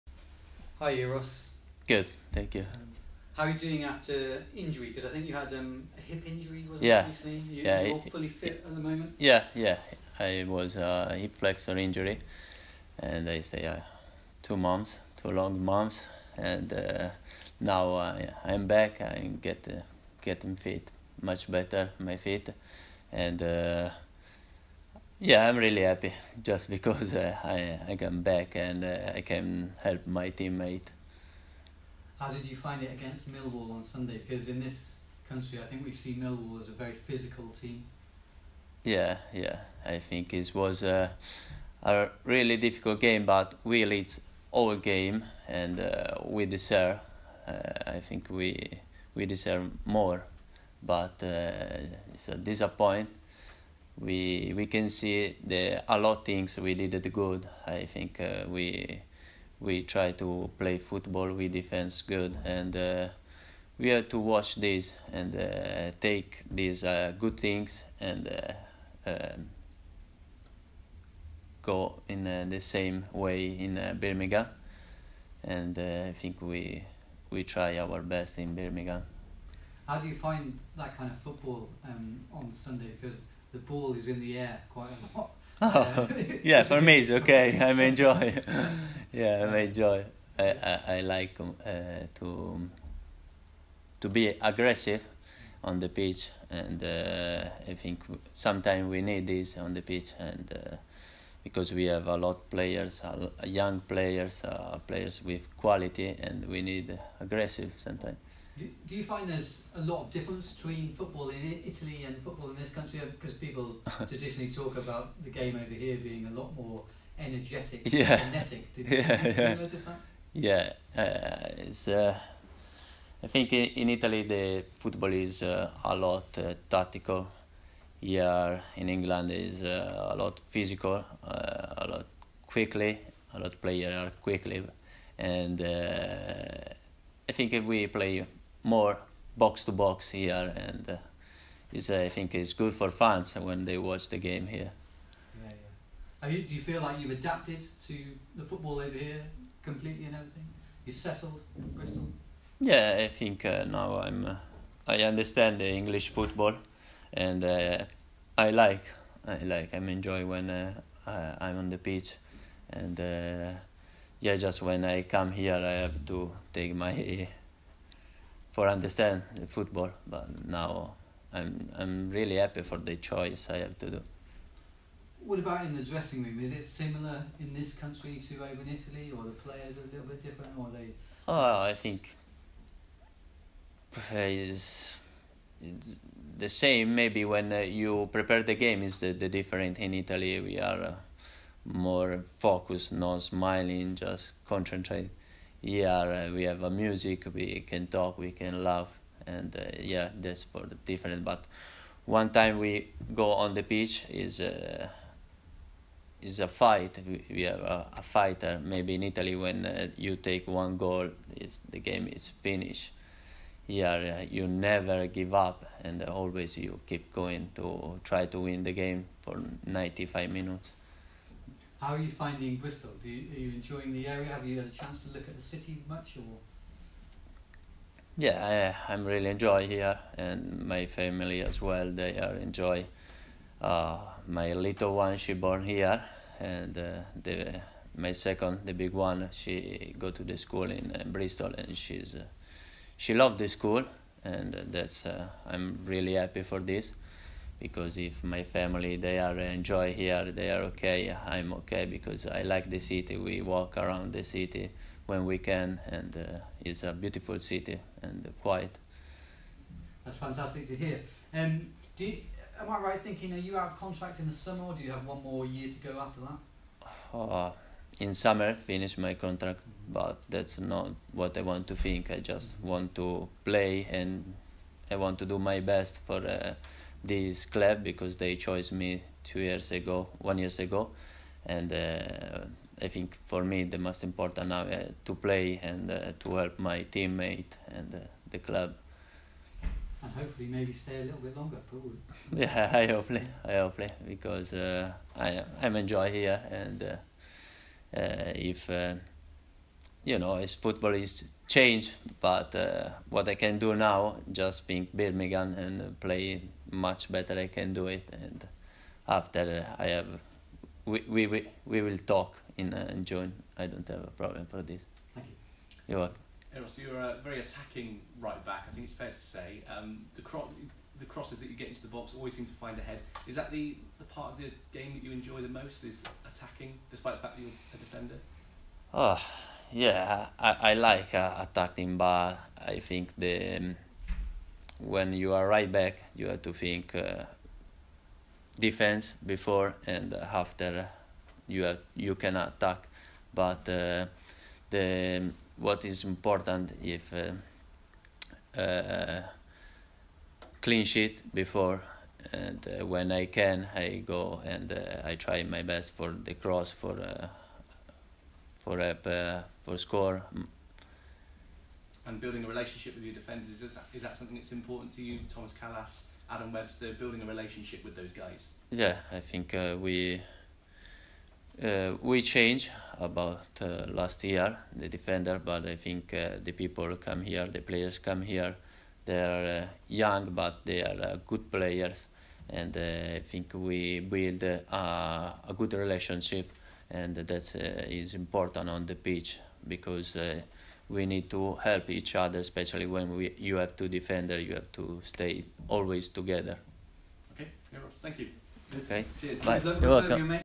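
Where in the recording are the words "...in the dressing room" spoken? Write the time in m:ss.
2:55.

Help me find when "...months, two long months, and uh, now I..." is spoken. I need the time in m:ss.
0:14.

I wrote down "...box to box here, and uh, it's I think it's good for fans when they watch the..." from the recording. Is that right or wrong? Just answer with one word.
right.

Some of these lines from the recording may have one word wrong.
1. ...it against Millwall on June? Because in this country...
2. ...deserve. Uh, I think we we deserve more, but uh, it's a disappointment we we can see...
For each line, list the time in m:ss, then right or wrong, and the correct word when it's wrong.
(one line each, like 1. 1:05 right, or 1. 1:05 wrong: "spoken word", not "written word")
1. 0:32 wrong: "Sunday", not "June"
2. 0:46 right.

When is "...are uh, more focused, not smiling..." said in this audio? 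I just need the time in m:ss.
3:10.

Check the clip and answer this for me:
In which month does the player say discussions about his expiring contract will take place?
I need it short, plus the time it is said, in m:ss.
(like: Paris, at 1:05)
June, at 5:13.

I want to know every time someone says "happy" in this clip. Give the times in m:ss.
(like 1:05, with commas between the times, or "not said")
0:25, 2:52, 4:06.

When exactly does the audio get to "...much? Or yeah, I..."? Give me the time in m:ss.
3:45.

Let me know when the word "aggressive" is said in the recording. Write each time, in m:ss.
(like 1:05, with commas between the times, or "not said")
1:34, 1:47.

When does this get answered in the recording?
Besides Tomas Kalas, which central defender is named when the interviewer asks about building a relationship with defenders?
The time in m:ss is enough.
6:06.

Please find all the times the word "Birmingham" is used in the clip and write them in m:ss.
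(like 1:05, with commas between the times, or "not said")
1:14, 1:18, 5:04.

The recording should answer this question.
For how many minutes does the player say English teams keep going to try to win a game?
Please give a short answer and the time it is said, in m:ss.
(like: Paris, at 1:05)
95, at 3:39.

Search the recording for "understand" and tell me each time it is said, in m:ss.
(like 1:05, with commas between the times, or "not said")
2:35, 2:48.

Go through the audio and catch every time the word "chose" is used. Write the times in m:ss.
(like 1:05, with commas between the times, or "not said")
4:38.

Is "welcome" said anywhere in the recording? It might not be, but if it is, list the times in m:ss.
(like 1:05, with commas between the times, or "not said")
5:15, 6:39.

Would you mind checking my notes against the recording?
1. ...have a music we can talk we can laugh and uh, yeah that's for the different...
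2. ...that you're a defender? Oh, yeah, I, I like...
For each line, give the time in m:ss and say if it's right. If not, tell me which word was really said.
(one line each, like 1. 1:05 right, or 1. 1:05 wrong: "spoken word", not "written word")
1. 3:16 right
2. 5:27 right.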